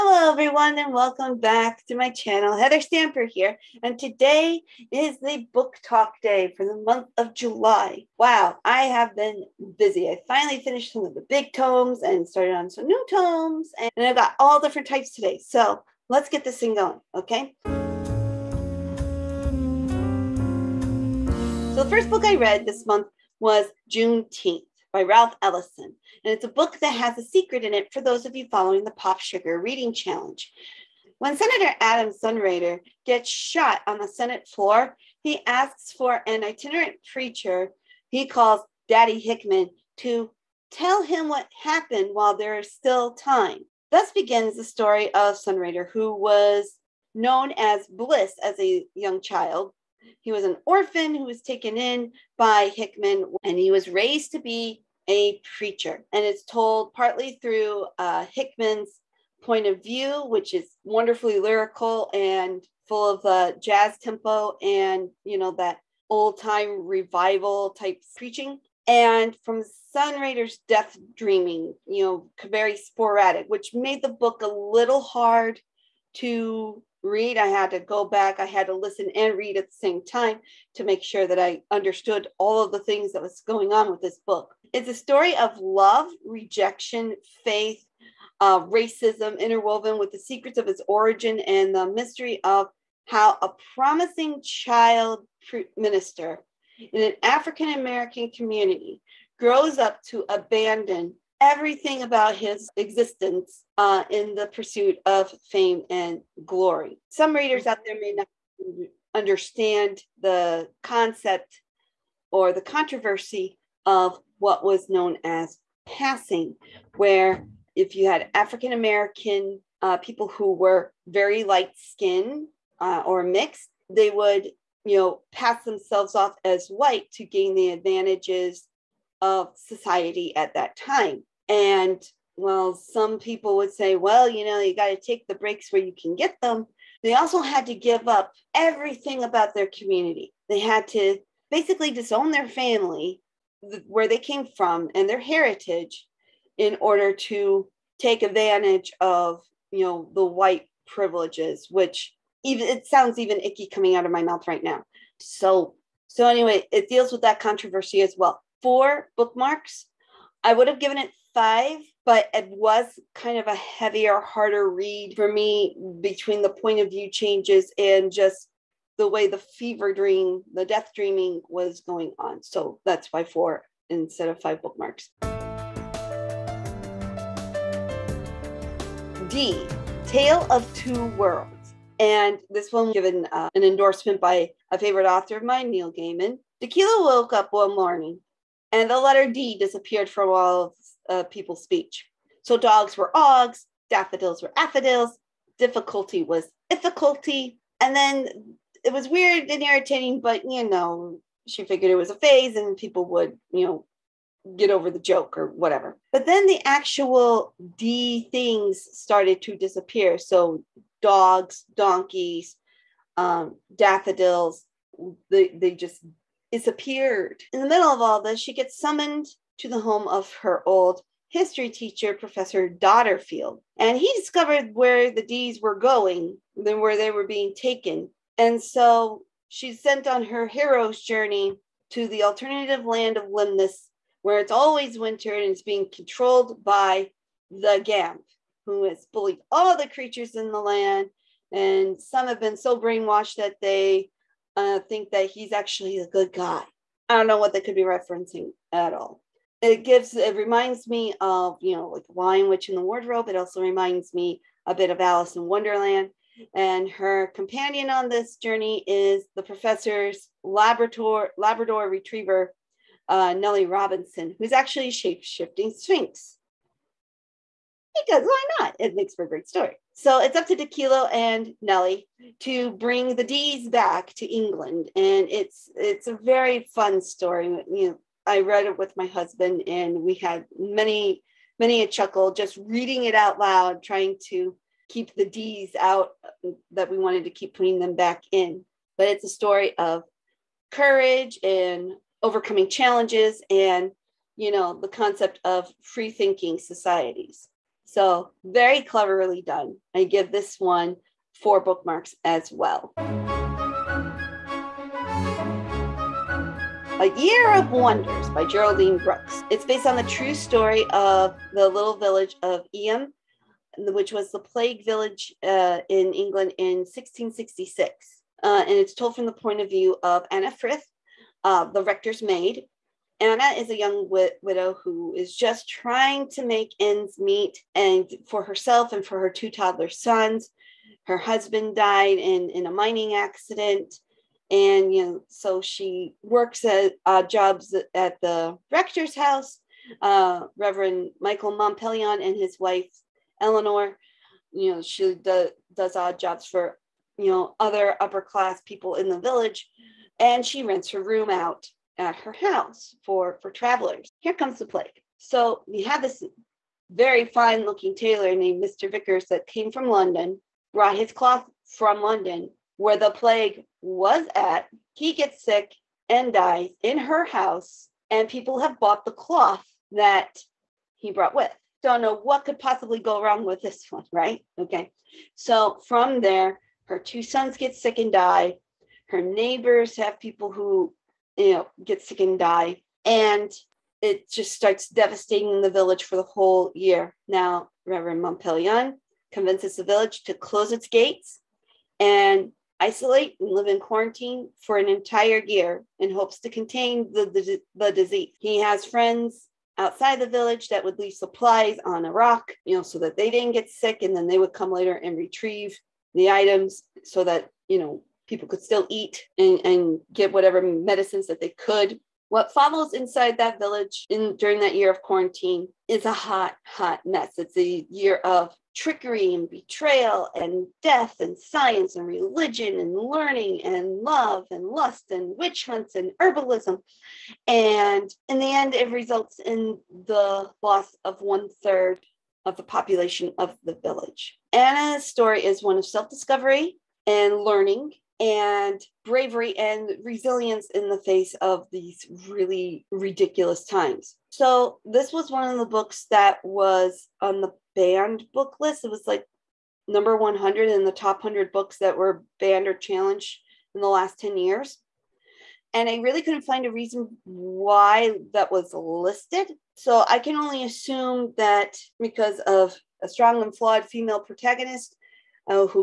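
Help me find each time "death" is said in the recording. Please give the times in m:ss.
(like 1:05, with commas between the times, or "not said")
1:10, 2:50, 7:00.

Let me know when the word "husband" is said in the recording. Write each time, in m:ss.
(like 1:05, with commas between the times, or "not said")
4:39, 5:31.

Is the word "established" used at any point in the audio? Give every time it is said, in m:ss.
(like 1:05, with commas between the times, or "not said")
not said.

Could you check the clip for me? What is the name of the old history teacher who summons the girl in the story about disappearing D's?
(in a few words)
Professor Dodderfield.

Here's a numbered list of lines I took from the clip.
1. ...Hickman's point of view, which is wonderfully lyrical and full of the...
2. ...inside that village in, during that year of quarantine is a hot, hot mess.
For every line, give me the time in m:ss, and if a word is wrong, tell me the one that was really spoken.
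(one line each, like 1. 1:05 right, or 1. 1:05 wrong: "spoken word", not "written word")
1. 0:58 right
2. 6:52 right.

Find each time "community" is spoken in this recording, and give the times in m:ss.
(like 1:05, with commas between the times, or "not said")
1:38, 2:19.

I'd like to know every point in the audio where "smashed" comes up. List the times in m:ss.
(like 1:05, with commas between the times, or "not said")
not said.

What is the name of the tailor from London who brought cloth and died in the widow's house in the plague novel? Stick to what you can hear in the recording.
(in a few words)
Mr. Viccars.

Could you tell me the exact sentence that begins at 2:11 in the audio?
And well, some people would say, well, you know, you got to take the breaks where you can get them.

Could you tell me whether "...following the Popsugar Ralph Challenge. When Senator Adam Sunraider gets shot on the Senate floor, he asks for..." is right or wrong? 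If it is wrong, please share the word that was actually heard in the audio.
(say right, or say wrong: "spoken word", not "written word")
wrong: "Reading", not "Ralph".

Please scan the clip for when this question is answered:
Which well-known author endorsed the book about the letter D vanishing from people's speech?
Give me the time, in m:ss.
3:05.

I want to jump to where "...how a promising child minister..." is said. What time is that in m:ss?
1:33.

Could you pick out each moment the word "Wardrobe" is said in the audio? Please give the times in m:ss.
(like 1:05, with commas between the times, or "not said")
4:12.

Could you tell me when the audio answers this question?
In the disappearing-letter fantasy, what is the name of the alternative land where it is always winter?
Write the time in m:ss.
3:53.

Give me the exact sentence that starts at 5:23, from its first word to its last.
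Anna is a young widow who is just trying to make ends meet and for herself and for her two toddler sons.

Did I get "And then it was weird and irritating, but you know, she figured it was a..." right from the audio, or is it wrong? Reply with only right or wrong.
right.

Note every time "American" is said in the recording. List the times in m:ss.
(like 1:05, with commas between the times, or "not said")
1:37, 1:58.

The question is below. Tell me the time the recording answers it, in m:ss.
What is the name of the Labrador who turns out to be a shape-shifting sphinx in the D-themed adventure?
4:23.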